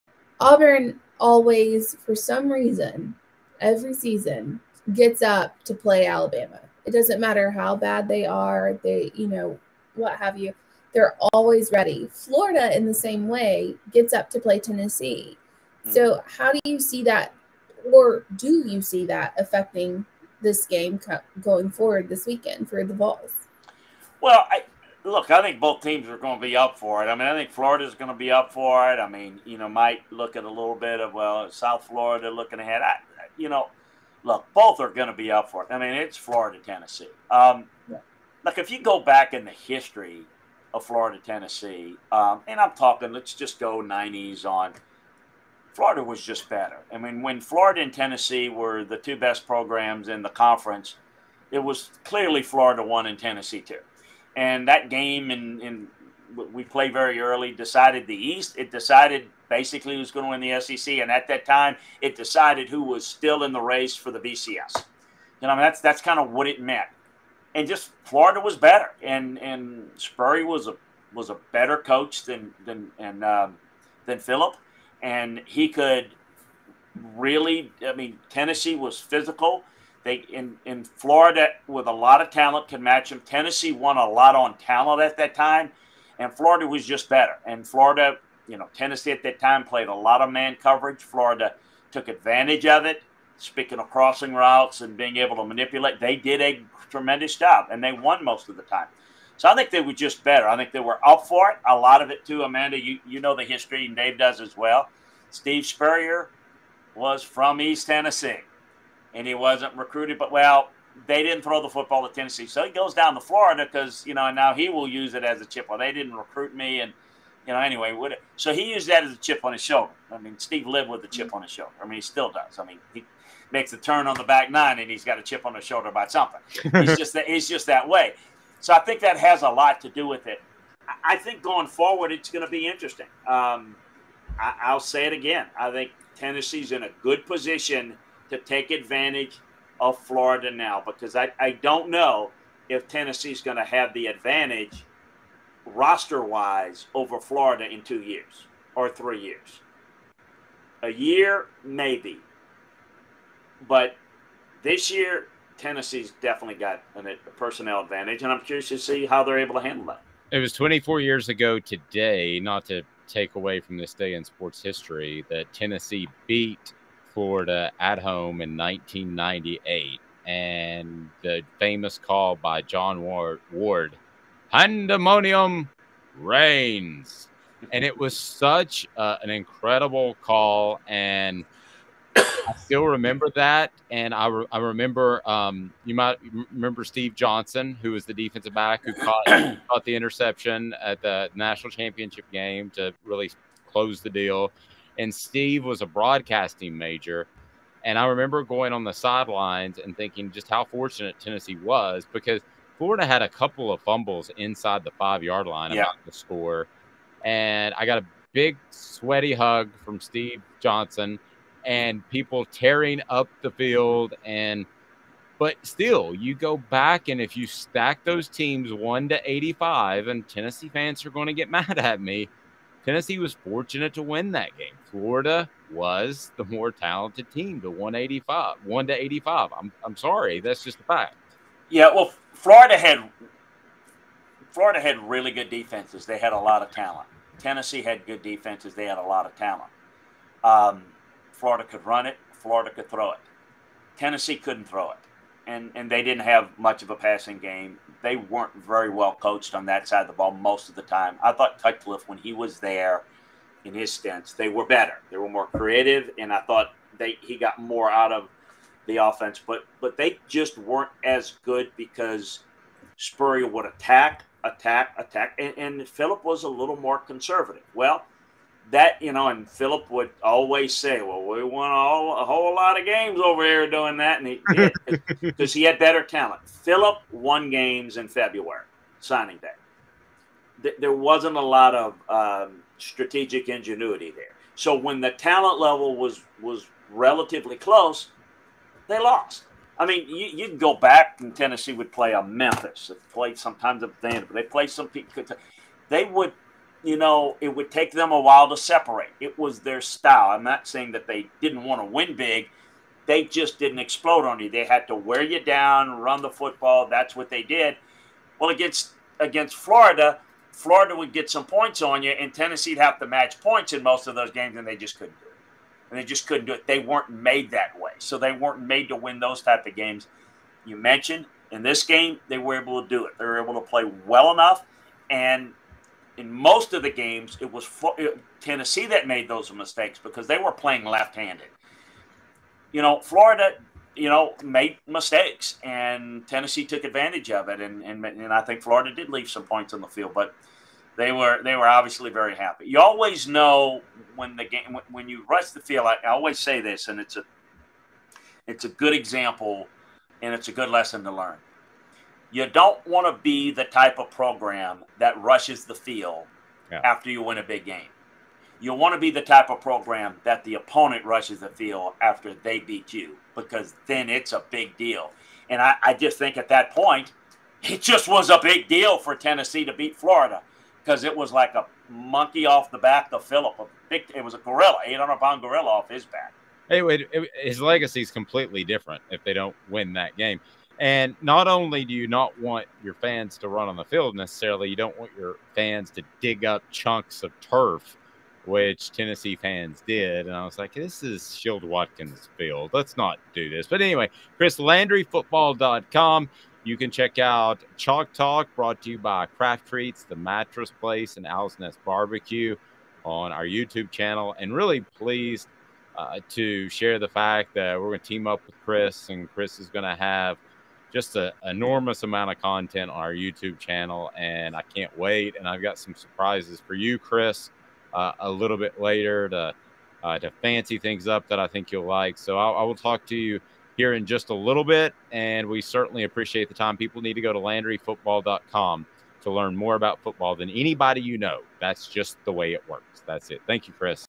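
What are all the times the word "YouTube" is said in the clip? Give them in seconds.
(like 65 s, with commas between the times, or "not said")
403 s, 413 s.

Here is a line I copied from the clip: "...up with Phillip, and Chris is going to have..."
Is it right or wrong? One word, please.
wrong.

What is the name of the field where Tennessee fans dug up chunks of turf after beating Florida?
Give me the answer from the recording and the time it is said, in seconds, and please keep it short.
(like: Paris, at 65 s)
Shield Watkins field, at 391 s.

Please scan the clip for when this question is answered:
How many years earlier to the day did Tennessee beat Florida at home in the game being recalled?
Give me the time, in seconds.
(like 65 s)
160 s.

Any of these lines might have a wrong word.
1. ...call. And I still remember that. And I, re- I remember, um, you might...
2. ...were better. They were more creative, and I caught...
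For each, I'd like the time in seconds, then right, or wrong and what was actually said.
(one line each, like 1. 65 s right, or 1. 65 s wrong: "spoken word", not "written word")
1. 180 s right
2. 254 s wrong: "thought", not "caught".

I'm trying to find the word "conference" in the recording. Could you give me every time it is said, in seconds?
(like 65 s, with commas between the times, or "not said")
50 s.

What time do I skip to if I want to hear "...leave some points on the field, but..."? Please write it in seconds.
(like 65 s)
339 s.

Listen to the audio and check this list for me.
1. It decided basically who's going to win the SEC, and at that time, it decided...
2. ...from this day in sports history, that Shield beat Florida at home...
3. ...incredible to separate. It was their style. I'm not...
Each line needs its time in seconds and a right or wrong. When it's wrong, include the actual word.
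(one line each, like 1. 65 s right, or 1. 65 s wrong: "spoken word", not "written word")
1. 58 s right
2. 163 s wrong: "Tennessee", not "Shield"
3. 298 s wrong: "while", not "incredible".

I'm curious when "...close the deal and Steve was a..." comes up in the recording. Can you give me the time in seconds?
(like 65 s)
193 s.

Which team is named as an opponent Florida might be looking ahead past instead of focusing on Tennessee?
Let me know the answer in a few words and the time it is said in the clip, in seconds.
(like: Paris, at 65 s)
South Florida, at 31 s.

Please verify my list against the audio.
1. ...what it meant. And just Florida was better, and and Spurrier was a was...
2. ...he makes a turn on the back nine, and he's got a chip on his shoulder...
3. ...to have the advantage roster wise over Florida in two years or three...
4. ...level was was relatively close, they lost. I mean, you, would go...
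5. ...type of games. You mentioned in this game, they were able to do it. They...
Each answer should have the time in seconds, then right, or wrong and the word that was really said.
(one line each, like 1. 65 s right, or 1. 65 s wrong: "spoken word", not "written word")
1. 66 s right
2. 122 s right
3. 143 s right
4. 285 s right
5. 319 s right.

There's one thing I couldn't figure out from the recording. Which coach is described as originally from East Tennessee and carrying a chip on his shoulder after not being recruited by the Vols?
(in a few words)
Steve Spurrier.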